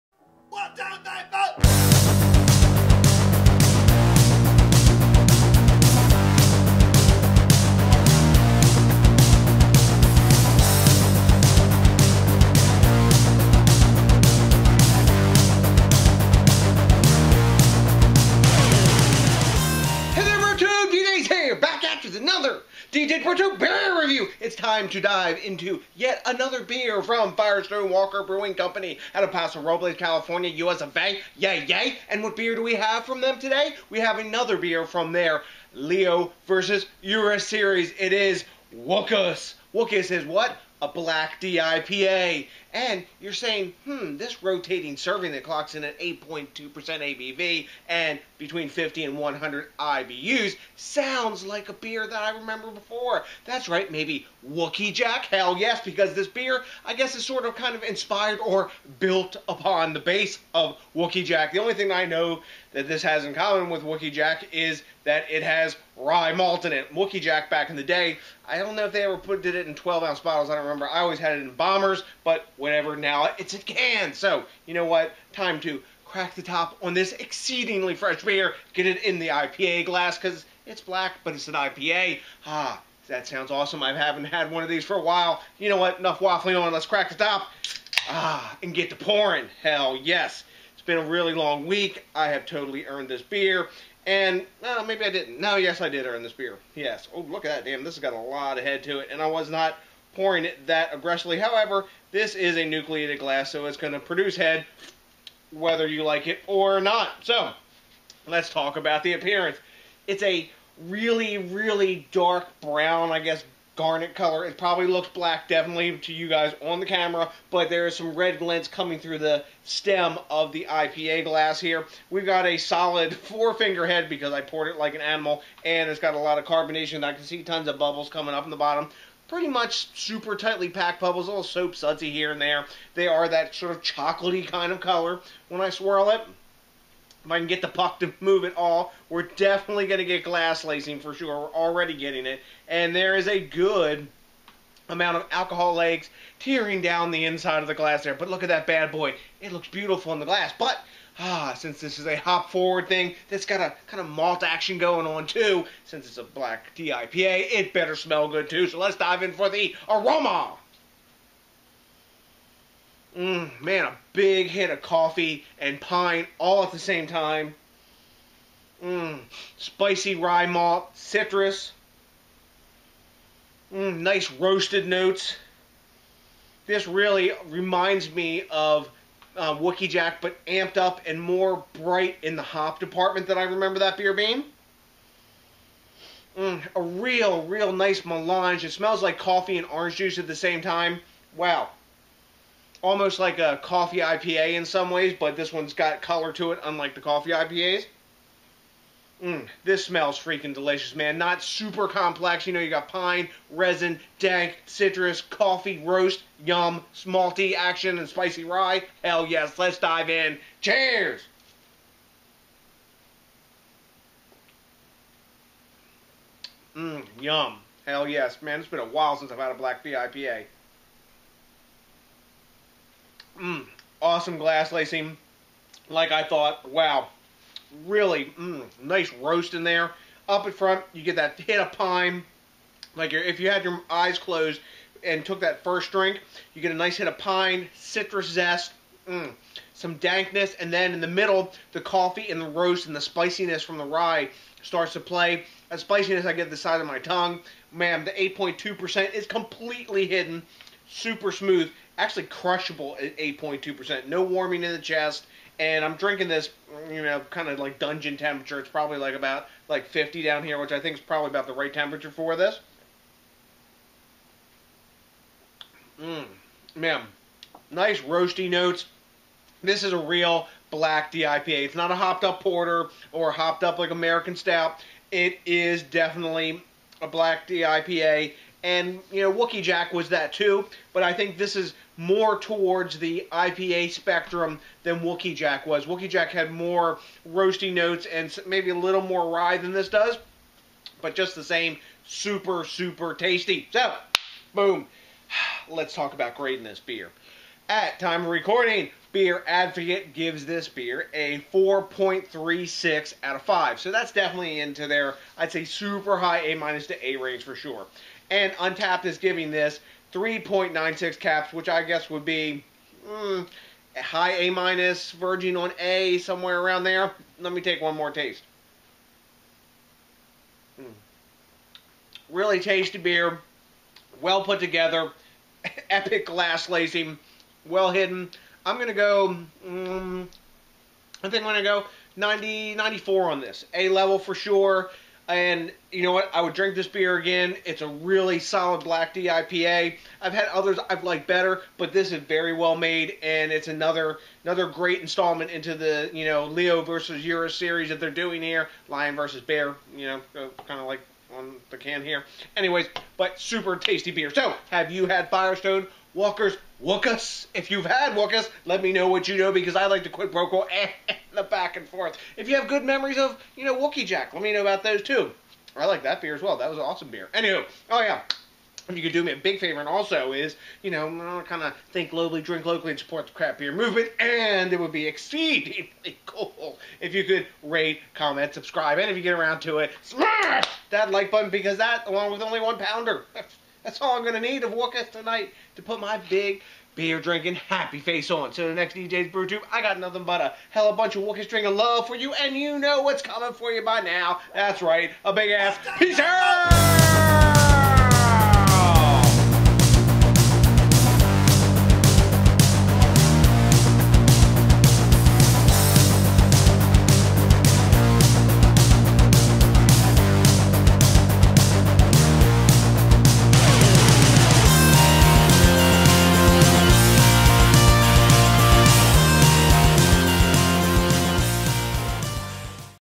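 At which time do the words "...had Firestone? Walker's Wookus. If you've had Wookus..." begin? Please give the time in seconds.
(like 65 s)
355 s.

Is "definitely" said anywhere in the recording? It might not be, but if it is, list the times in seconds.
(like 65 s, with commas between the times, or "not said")
115 s, 139 s, 275 s, 304 s.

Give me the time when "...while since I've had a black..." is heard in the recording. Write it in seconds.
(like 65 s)
218 s.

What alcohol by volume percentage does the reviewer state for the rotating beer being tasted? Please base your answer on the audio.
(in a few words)
8.2%.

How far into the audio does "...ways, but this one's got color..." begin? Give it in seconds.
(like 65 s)
194 s.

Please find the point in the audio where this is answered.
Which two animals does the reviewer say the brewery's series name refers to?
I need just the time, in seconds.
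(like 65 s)
348 s.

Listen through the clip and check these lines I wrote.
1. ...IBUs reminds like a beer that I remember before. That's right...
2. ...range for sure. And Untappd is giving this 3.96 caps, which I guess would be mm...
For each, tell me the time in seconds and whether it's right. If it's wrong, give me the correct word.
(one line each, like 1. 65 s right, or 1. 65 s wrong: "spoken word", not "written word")
1. 49 s wrong: "sounds", not "reminds"
2. 307 s right.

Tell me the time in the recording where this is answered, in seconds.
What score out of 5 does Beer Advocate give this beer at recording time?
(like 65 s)
301 s.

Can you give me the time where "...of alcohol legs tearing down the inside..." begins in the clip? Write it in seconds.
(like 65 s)
145 s.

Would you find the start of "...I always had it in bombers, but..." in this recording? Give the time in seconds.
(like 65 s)
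70 s.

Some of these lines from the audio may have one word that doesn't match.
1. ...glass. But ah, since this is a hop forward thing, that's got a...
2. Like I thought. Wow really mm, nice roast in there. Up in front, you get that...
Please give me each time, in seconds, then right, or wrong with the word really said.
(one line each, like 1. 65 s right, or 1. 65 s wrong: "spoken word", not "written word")
1. 150 s right
2. 225 s right.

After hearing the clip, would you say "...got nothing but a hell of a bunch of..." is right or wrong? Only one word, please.
right.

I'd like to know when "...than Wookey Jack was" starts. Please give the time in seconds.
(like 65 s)
284 s.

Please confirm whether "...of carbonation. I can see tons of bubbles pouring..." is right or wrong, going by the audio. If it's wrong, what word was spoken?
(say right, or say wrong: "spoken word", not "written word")
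wrong: "coming", not "pouring".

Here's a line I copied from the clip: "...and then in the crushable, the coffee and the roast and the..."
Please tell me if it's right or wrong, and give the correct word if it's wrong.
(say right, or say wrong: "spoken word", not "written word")
wrong: "middle", not "crushable".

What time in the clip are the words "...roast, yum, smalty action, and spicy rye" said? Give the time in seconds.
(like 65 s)
205 s.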